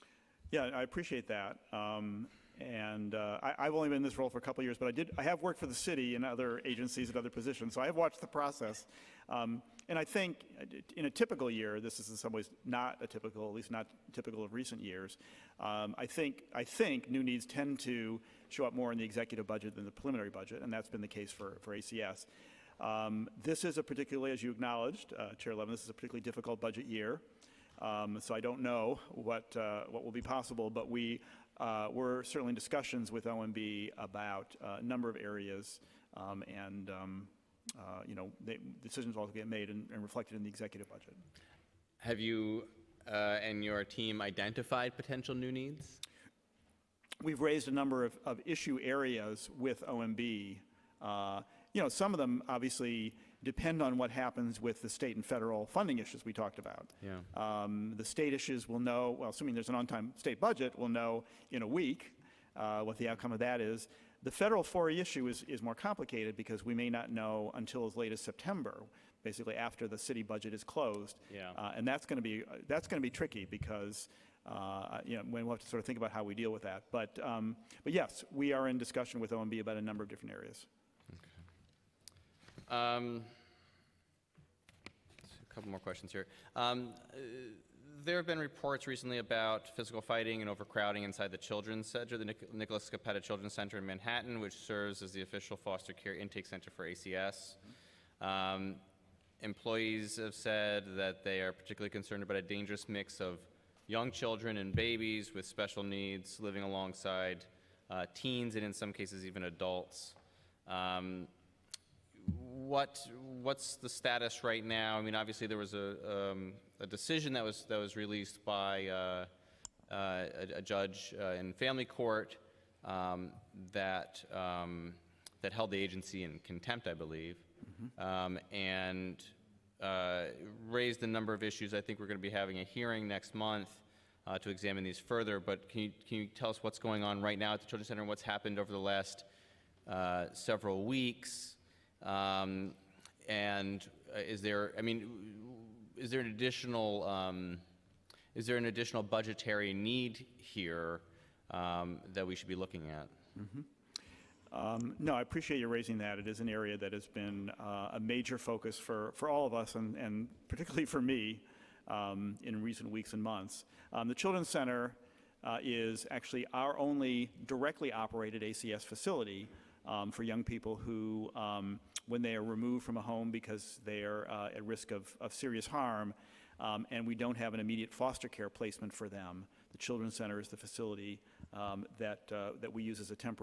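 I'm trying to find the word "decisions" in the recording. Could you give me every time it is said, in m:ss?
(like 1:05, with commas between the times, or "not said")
0:38, 1:56.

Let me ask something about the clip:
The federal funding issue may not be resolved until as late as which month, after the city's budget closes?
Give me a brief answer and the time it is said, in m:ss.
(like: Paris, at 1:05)
September, at 1:08.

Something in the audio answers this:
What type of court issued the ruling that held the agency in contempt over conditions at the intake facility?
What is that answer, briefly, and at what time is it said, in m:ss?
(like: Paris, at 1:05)
Family court, at 2:01.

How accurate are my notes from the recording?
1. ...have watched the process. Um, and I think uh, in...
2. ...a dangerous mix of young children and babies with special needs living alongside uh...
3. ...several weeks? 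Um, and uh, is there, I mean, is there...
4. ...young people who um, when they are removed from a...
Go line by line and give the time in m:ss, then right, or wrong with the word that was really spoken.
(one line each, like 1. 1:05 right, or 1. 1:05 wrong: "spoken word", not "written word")
1. 0:07 right
2. 1:42 right
3. 2:20 right
4. 2:50 right.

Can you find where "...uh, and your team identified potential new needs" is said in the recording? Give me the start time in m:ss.
0:43.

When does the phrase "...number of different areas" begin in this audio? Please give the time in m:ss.
1:19.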